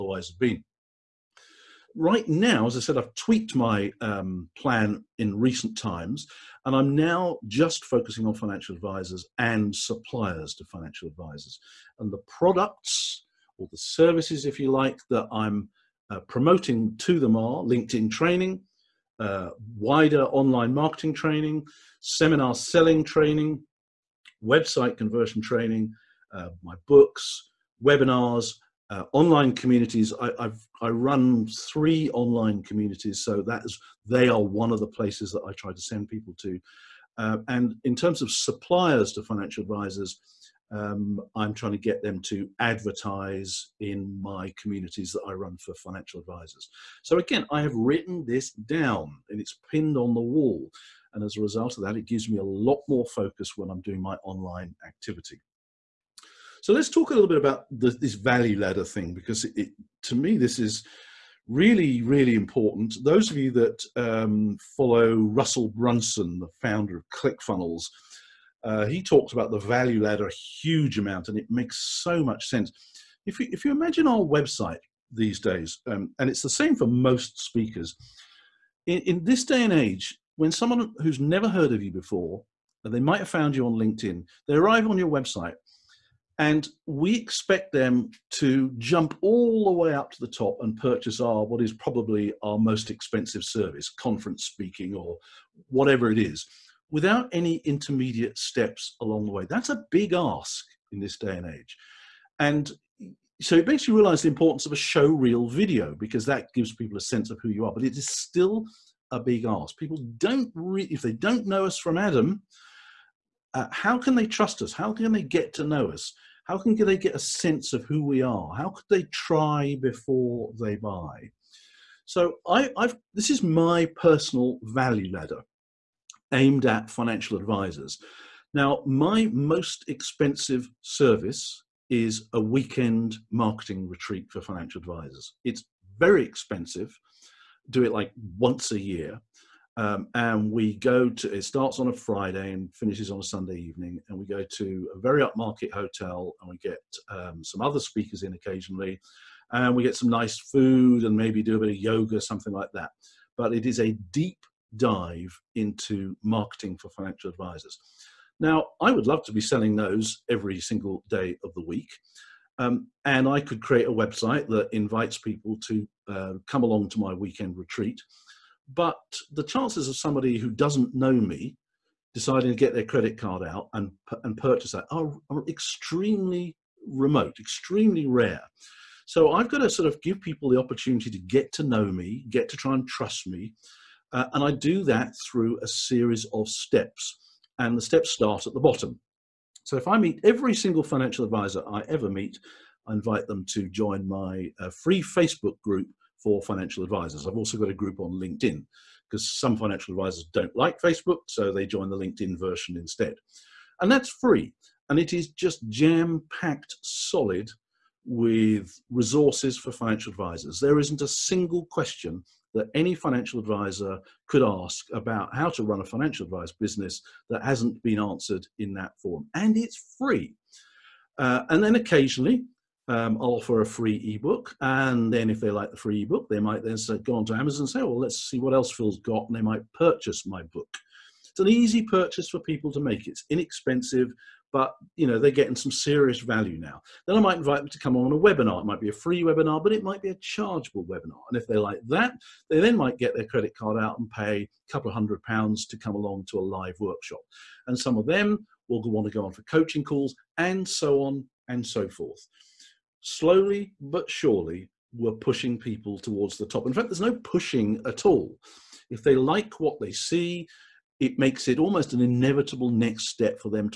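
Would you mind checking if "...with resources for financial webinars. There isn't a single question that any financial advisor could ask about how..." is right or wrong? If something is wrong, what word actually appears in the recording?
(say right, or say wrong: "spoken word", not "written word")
wrong: "advisors", not "webinars".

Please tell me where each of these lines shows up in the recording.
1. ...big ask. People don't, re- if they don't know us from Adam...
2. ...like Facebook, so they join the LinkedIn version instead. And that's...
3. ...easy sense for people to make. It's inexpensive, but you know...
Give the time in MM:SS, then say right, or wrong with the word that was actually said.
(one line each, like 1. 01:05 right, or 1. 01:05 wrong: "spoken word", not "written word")
1. 01:49 right
2. 03:20 right
3. 03:51 wrong: "purchase", not "sense".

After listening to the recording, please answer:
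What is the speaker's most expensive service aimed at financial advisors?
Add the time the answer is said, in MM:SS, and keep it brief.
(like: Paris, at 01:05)
Weekend marketing retreat, at 02:12.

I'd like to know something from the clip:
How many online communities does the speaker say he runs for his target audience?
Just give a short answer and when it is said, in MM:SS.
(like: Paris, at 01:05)
3, at 00:31.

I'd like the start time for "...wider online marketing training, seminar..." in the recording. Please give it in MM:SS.
00:19.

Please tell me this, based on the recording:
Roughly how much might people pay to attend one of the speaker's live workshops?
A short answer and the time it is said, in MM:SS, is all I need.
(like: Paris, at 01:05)
A couple of hundred pounds, at 04:04.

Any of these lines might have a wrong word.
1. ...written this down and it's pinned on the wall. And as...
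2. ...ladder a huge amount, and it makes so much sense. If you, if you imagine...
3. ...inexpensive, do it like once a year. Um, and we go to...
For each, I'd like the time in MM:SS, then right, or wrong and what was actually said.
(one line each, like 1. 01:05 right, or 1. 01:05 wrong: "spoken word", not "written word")
1. 00:47 right
2. 01:10 right
3. 02:16 wrong: "expensive", not "inexpensive".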